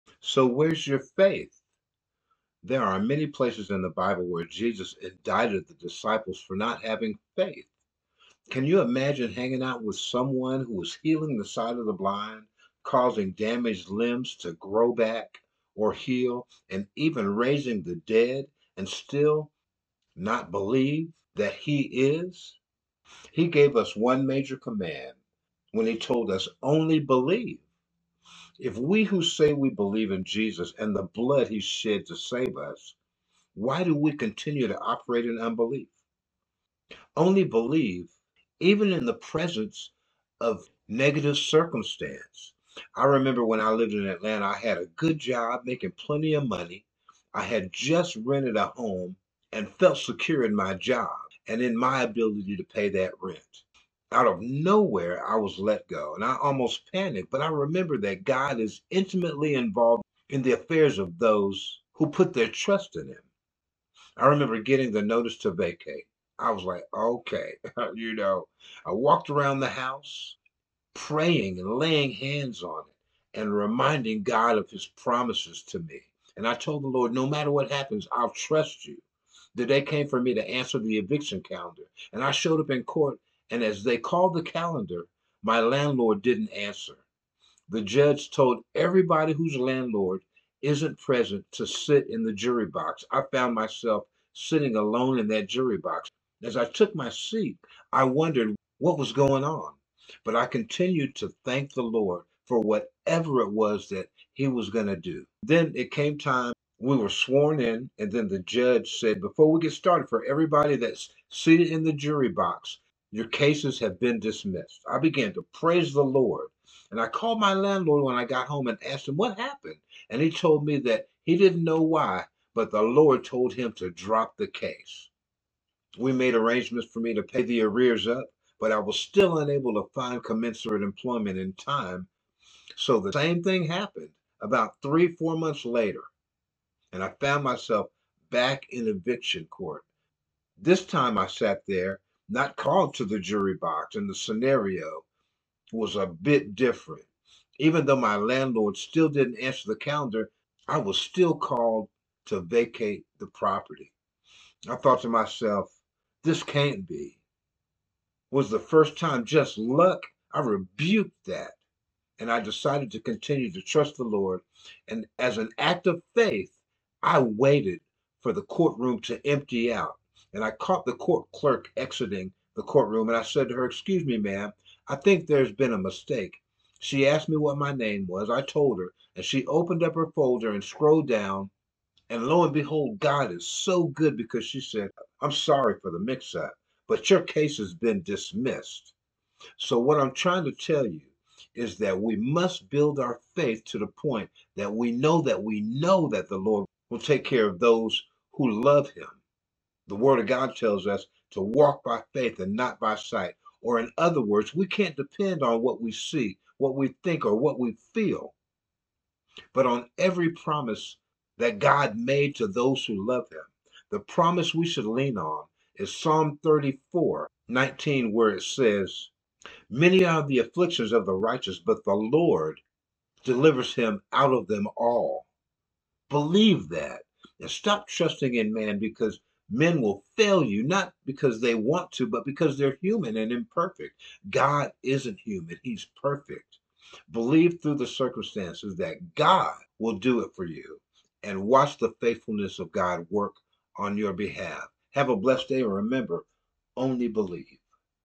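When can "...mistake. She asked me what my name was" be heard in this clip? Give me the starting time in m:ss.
2:55.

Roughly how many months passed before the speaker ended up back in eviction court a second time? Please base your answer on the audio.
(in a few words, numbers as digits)
3 or 4 months.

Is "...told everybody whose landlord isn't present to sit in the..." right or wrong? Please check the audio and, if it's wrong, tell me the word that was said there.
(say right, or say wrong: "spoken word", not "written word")
right.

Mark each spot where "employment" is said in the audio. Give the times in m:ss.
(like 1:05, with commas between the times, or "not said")
2:10.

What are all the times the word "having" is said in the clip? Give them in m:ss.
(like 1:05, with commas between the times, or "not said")
0:06.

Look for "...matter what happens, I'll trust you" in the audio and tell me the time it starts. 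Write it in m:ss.
1:17.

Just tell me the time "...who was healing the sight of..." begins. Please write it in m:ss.
0:10.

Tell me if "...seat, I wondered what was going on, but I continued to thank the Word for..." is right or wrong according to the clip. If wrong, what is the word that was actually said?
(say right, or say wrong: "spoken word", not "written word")
wrong: "Lord", not "Word".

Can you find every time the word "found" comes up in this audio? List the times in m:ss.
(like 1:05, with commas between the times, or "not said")
1:33, 2:17.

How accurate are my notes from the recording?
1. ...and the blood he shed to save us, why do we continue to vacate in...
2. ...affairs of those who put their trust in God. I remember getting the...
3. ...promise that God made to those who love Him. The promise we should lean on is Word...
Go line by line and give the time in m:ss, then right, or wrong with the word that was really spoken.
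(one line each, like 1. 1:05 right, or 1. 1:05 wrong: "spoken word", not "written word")
1. 0:30 wrong: "operate", not "vacate"
2. 1:00 wrong: "Him", not "God"
3. 3:30 wrong: "Psalm", not "Word".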